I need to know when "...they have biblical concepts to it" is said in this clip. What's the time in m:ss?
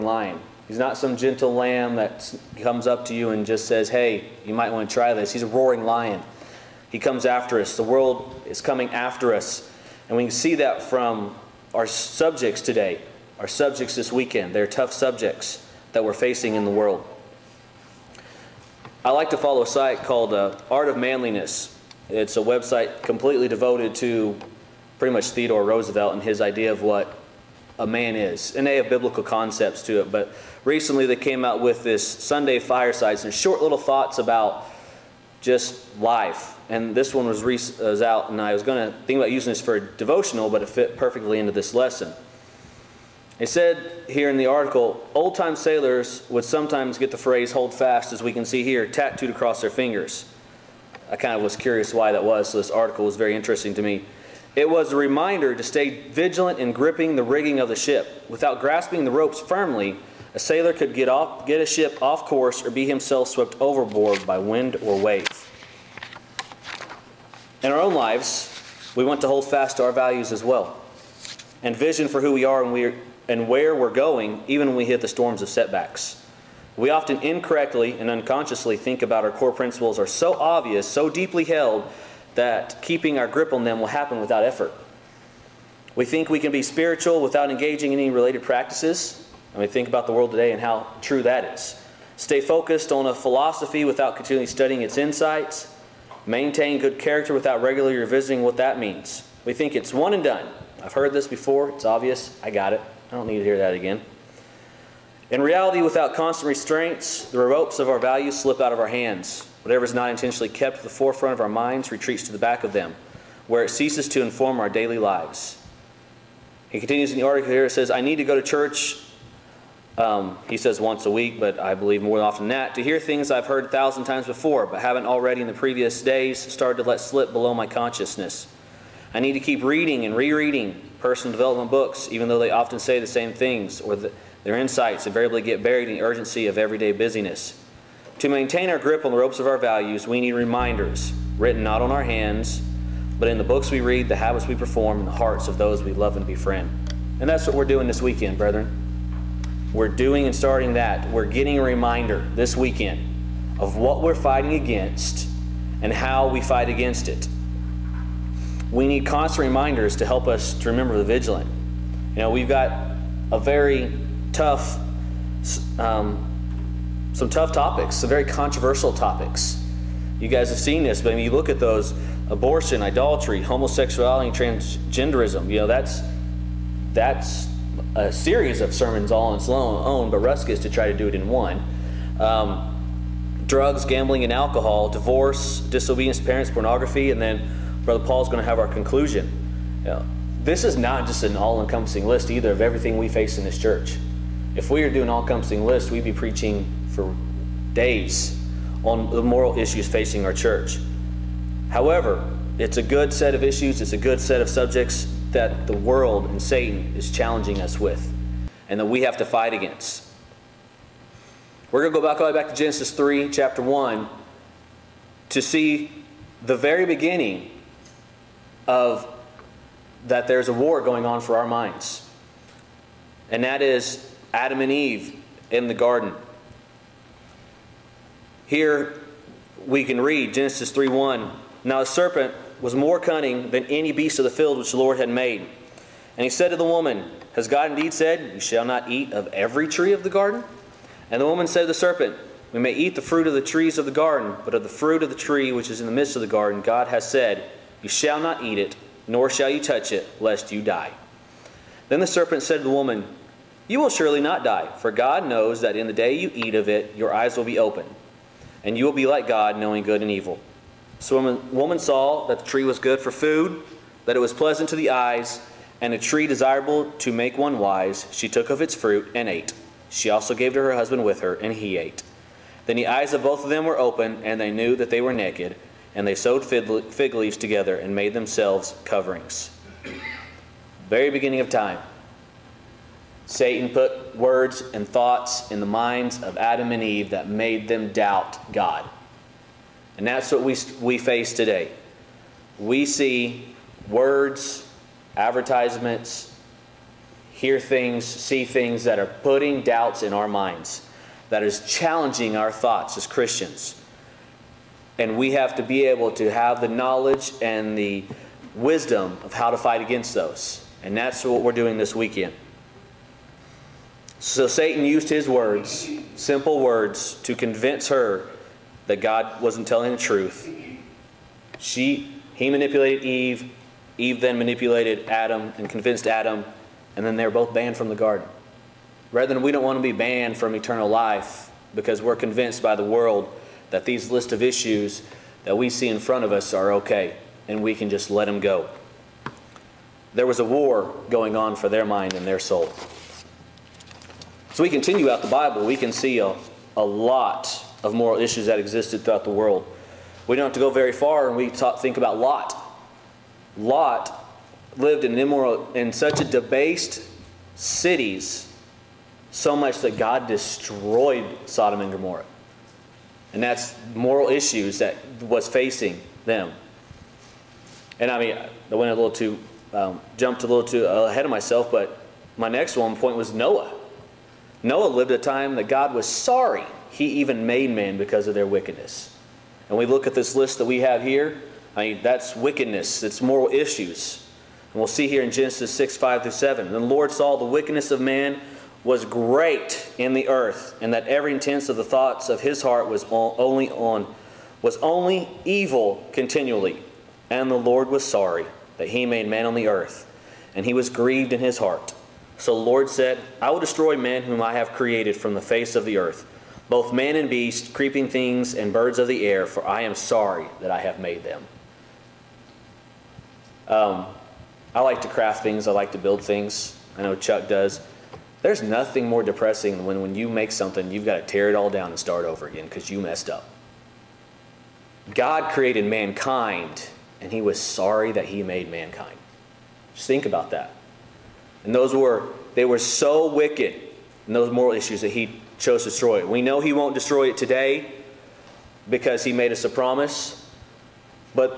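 0:28.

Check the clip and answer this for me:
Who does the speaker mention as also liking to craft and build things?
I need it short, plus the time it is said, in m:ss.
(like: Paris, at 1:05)
Chuck, at 6:57.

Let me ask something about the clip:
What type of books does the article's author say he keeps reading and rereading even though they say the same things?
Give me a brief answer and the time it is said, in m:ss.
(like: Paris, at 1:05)
Personal development books, at 2:10.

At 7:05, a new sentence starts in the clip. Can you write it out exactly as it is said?
God created mankind, and he was sorry that he made mankind.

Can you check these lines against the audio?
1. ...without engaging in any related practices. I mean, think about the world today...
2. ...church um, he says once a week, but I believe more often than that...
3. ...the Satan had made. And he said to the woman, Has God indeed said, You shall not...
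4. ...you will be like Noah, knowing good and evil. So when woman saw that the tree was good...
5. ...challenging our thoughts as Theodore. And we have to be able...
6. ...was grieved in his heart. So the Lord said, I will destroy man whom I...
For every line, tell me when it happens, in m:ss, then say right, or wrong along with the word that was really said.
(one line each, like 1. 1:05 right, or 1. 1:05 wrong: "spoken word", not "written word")
1. 1:27 right
2. 1:58 right
3. 3:54 wrong: "Lord", not "Satan"
4. 4:18 wrong: "God", not "Noah"
5. 5:01 wrong: "Christians", not "Theodore"
6. 6:40 right.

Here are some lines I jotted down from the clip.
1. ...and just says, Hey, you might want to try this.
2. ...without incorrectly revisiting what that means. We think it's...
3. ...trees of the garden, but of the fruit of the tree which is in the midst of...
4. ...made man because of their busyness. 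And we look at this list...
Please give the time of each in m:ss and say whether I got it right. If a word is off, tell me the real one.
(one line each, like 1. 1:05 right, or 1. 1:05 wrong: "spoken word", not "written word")
1. 0:03 right
2. 1:37 wrong: "regularly", not "incorrectly"
3. 4:03 right
4. 6:17 wrong: "wickedness", not "busyness".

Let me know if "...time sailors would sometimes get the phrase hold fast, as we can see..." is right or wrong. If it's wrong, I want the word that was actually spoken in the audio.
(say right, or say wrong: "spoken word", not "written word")
right.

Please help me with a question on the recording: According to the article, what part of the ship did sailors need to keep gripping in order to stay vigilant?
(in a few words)
The rigging.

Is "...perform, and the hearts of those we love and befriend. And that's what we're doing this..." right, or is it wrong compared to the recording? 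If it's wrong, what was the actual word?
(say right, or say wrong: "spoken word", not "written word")
right.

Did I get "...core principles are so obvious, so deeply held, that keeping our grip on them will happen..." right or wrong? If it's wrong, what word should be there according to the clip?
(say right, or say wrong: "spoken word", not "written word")
right.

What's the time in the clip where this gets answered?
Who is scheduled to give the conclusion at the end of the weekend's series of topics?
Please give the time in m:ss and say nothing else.
3:07.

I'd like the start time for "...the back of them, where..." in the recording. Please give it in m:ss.
1:52.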